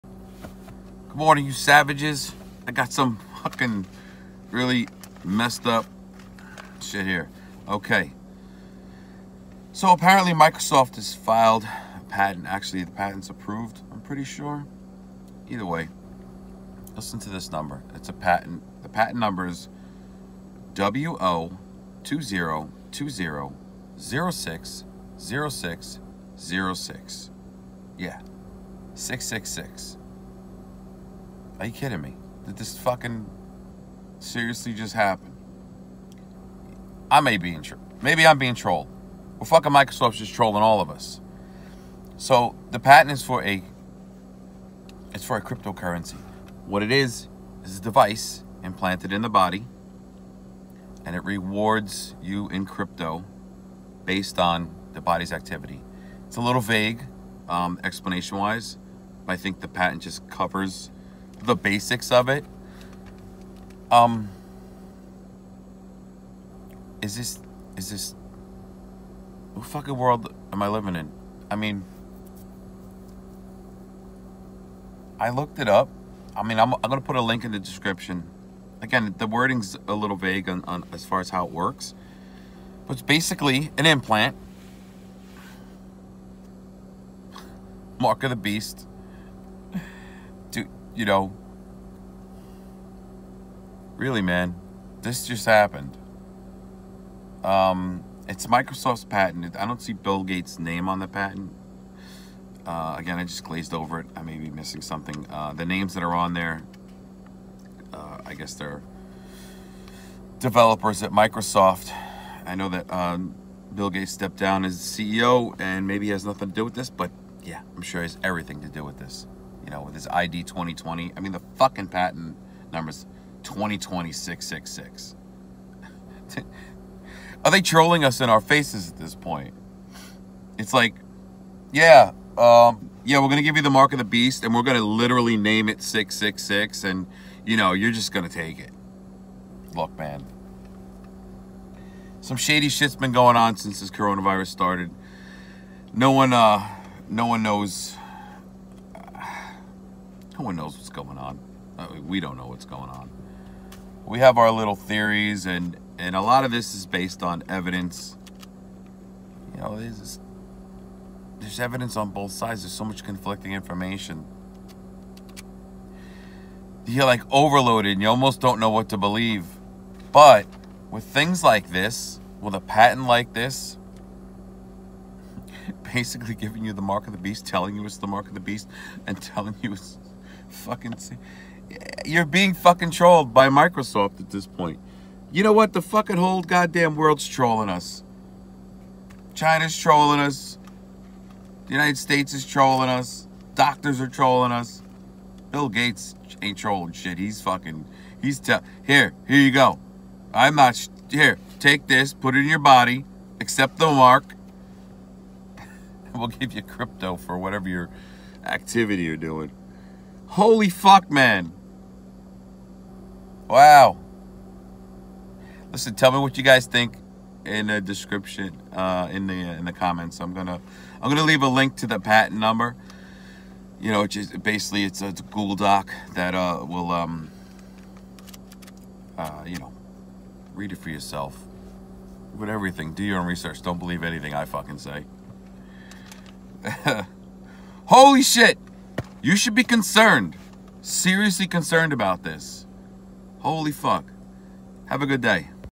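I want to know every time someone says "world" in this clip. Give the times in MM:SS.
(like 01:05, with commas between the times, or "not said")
01:09, 03:06.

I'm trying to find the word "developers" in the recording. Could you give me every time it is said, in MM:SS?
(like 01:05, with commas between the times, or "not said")
01:50.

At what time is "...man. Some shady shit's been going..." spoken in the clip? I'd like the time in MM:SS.
02:19.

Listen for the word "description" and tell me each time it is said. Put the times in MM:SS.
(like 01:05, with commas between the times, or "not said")
01:17, 03:37.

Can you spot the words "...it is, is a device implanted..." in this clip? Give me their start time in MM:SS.
00:46.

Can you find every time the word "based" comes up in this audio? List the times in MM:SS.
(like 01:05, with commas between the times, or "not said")
00:54, 02:36.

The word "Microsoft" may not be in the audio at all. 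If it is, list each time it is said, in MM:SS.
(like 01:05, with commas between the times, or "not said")
00:10, 00:39, 01:38, 01:51, 03:03.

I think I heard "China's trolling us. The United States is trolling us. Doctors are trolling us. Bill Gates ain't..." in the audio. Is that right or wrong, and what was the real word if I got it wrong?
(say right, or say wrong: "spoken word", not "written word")
right.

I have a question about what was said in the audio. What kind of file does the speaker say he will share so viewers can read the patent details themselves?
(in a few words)
Google Doc.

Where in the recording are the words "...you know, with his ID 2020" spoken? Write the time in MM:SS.
01:59.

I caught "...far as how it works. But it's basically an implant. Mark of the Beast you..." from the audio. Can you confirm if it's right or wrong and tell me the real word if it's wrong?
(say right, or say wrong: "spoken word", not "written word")
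right.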